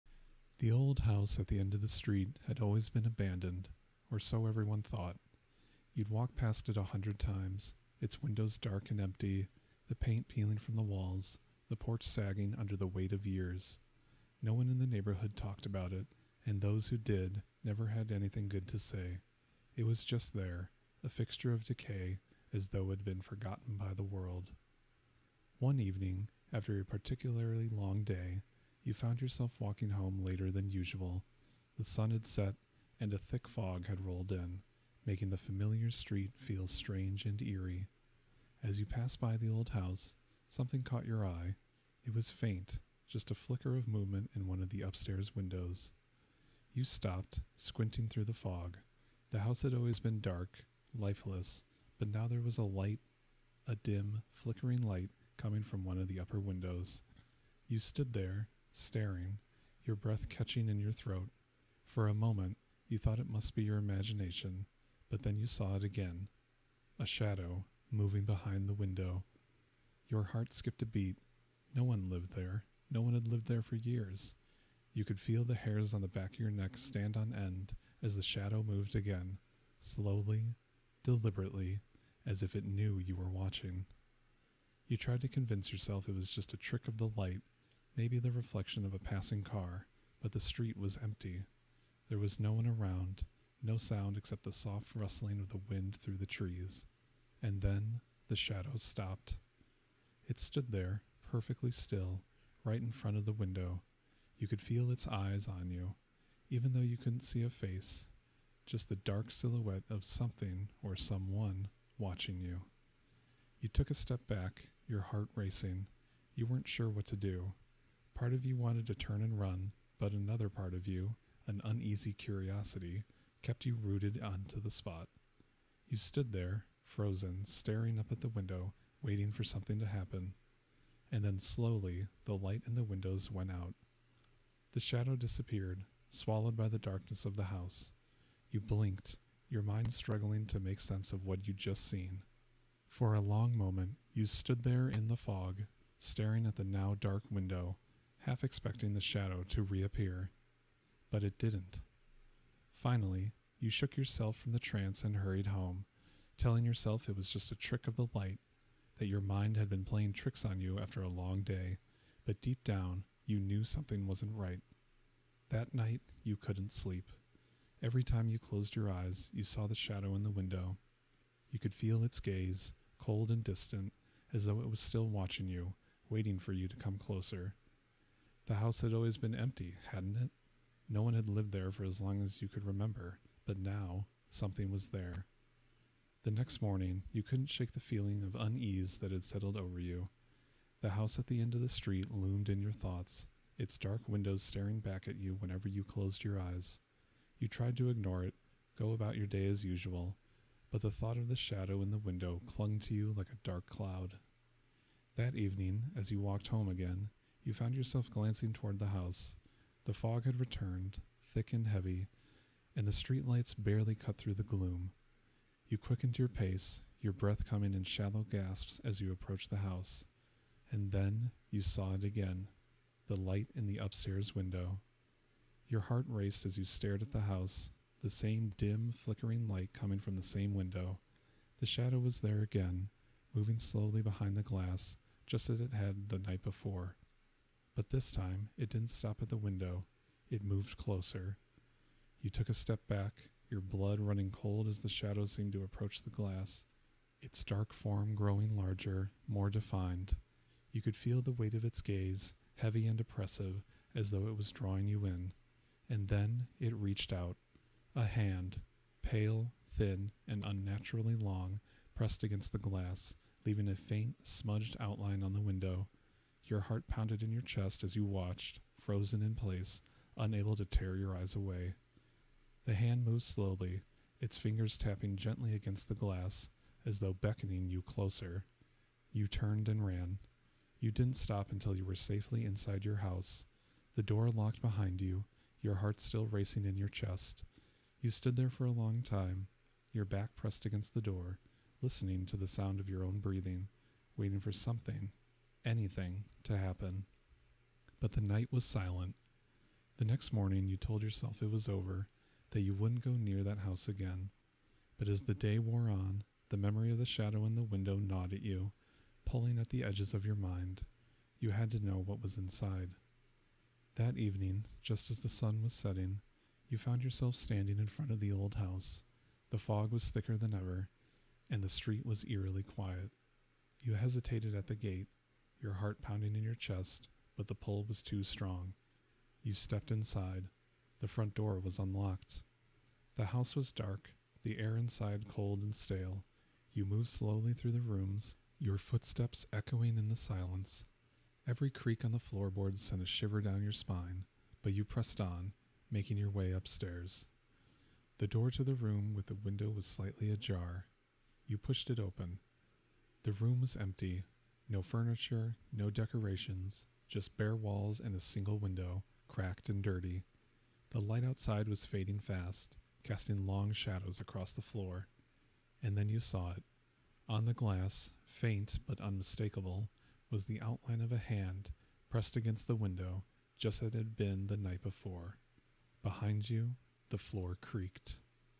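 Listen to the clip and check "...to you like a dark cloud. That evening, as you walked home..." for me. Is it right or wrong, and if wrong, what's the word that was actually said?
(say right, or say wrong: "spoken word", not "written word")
right.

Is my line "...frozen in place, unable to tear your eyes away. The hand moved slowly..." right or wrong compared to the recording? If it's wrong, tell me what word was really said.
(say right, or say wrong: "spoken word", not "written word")
right.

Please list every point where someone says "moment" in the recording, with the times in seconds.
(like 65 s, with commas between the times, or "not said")
62 s, 143 s.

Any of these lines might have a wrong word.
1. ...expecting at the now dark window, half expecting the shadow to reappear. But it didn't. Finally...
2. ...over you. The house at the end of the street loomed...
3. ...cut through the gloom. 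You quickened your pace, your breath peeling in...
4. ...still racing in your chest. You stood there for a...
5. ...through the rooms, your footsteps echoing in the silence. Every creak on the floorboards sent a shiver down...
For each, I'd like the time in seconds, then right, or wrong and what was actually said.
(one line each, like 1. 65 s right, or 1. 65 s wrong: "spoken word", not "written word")
1. 145 s wrong: "staring", not "expecting"
2. 189 s right
3. 213 s wrong: "coming", not "peeling"
4. 286 s right
5. 337 s right.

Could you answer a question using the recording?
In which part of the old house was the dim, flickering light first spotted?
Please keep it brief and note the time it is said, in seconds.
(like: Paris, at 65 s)
Upstairs window, at 44 s.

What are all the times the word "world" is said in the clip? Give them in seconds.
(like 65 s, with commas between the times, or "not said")
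24 s.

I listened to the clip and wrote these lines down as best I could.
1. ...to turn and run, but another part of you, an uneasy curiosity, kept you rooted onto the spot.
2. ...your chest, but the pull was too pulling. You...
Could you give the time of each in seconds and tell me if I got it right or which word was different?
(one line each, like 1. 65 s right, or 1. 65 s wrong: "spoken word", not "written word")
1. 118 s right
2. 326 s wrong: "strong", not "pulling".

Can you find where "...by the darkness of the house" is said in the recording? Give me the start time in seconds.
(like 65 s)
136 s.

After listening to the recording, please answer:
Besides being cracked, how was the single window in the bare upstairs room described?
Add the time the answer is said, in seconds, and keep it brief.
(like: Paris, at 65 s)
Dirty, at 359 s.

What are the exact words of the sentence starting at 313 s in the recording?
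That evening, just as the sun was setting, you found yourself standing in front of the old house.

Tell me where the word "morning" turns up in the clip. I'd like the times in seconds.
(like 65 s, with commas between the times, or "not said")
186 s, 300 s.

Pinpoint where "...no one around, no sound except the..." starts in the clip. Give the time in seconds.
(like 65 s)
92 s.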